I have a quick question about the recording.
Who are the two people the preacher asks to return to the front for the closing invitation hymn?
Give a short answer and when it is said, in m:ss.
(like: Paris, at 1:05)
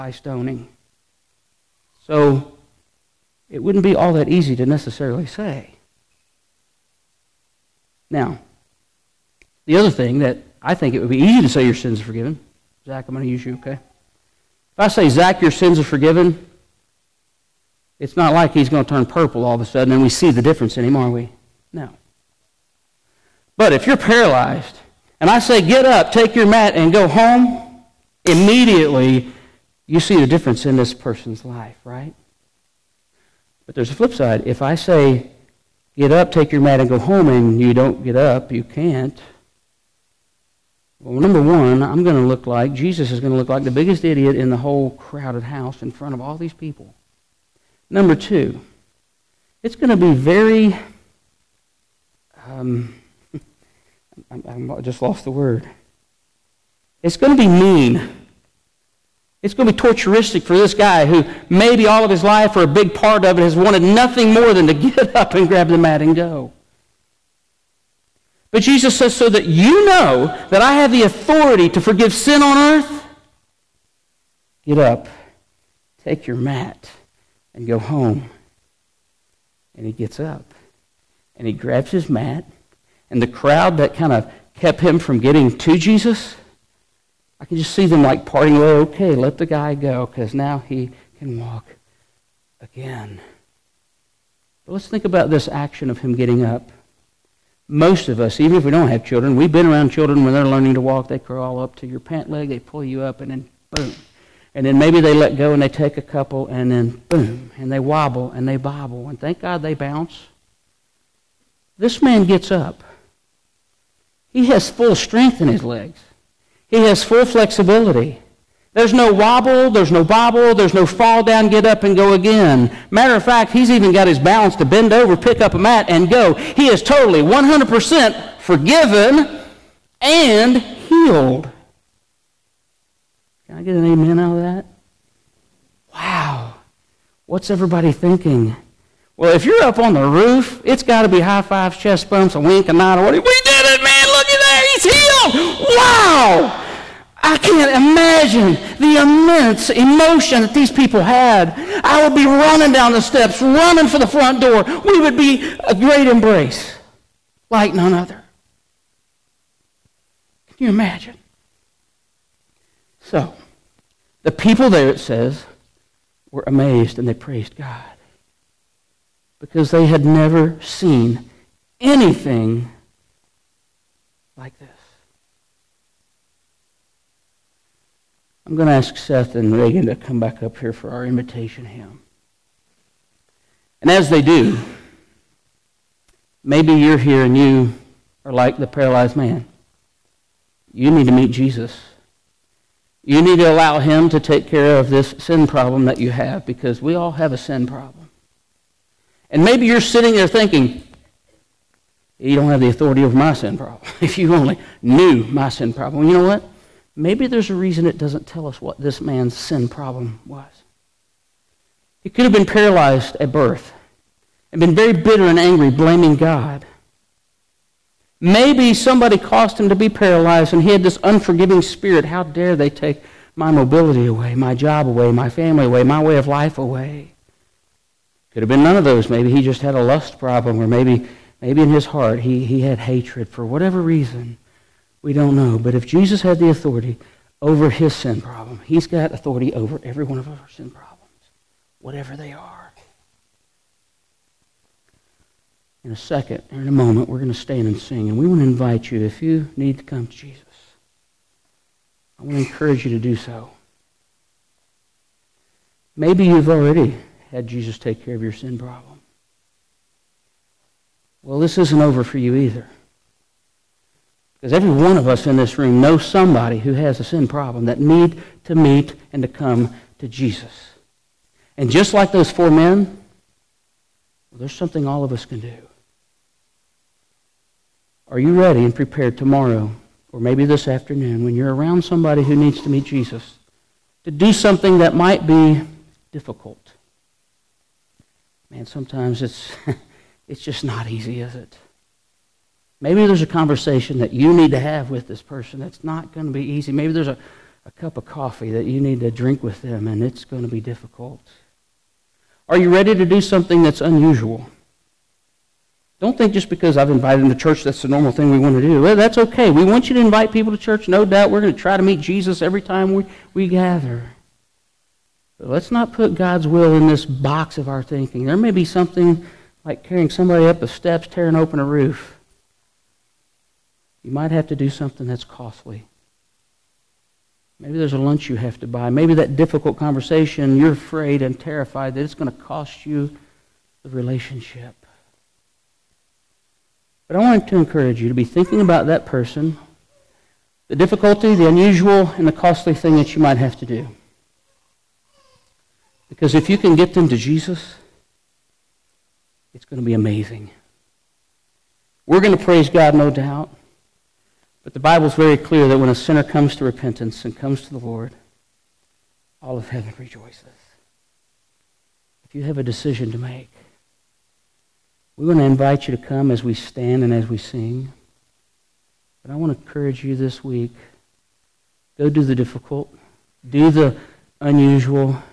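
Seth and Reagan, at 2:58.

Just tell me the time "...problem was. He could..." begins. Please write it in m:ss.
3:29.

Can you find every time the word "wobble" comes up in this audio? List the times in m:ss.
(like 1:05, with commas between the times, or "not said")
1:47, 1:59.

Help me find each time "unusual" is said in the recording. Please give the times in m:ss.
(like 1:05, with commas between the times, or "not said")
5:03, 5:41, 6:14.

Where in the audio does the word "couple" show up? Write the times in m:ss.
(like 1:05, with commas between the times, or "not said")
1:46.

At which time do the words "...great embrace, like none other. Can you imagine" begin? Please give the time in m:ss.
2:35.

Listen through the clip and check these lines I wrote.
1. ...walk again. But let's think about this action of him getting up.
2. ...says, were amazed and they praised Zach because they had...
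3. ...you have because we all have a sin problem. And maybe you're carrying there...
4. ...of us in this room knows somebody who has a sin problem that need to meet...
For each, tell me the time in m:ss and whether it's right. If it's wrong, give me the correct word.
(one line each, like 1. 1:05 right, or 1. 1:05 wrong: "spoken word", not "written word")
1. 1:31 right
2. 2:45 wrong: "God", not "Zach"
3. 3:15 wrong: "sitting", not "carrying"
4. 4:24 right.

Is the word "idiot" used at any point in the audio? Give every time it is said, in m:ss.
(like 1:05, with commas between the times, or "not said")
0:44.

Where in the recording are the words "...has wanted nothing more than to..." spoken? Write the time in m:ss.
1:03.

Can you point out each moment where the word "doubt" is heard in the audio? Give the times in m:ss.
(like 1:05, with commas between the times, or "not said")
5:11, 5:53.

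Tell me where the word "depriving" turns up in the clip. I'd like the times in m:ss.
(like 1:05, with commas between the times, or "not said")
not said.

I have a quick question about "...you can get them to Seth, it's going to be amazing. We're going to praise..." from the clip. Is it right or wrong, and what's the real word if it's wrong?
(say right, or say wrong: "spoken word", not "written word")
wrong: "Jesus", not "Seth".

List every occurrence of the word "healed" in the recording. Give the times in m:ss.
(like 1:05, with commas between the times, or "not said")
2:10, 2:24.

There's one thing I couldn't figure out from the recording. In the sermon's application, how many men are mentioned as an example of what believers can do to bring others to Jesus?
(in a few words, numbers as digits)
4.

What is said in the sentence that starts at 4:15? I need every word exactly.
Maybe you've already had Jesus take care of your sin problem.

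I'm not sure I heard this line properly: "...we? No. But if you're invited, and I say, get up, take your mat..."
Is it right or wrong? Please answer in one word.
wrong.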